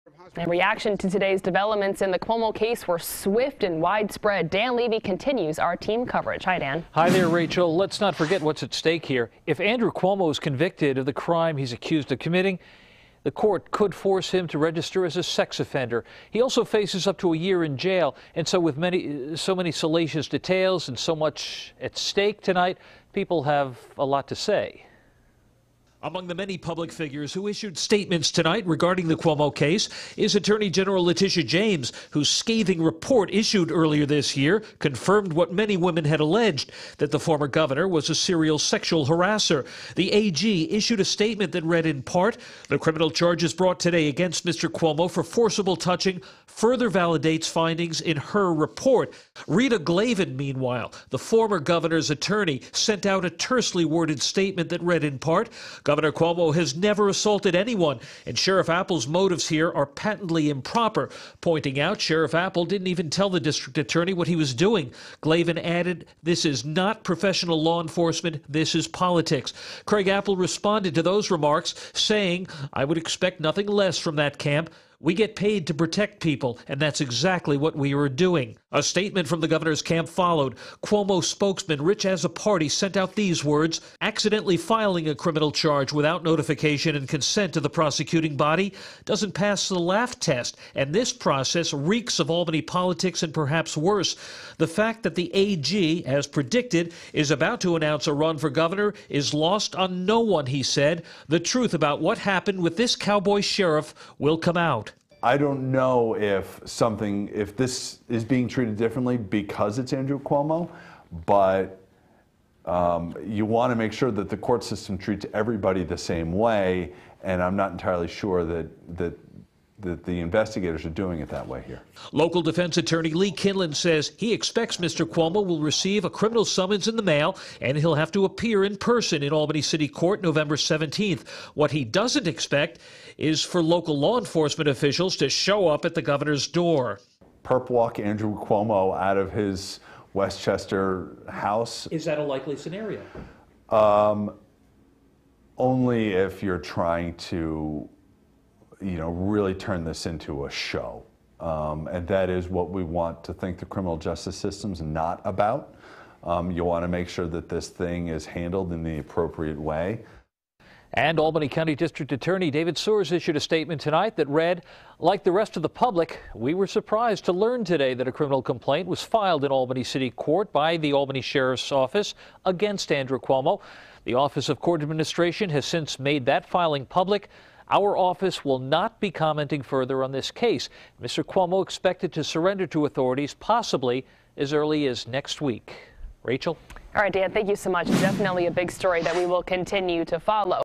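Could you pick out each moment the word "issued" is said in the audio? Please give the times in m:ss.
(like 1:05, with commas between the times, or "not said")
0:27, 0:33, 0:40, 2:43.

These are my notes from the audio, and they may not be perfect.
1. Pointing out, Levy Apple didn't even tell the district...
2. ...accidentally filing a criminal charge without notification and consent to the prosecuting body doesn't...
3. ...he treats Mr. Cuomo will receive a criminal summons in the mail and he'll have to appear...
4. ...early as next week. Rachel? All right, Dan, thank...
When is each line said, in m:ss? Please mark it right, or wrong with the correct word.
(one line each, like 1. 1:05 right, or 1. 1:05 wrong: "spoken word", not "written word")
1. 1:01 wrong: "Sheriff", not "Levy"
2. 1:24 right
3. 2:04 wrong: "expects", not "treats"
4. 3:04 right.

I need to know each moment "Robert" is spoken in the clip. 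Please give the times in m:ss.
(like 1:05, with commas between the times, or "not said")
not said.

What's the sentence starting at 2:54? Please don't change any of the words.
The Office of Court Administration has since made that filing public.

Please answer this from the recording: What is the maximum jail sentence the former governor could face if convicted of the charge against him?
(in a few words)
1 year.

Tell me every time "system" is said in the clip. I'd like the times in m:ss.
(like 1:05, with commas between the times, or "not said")
1:54, 2:34.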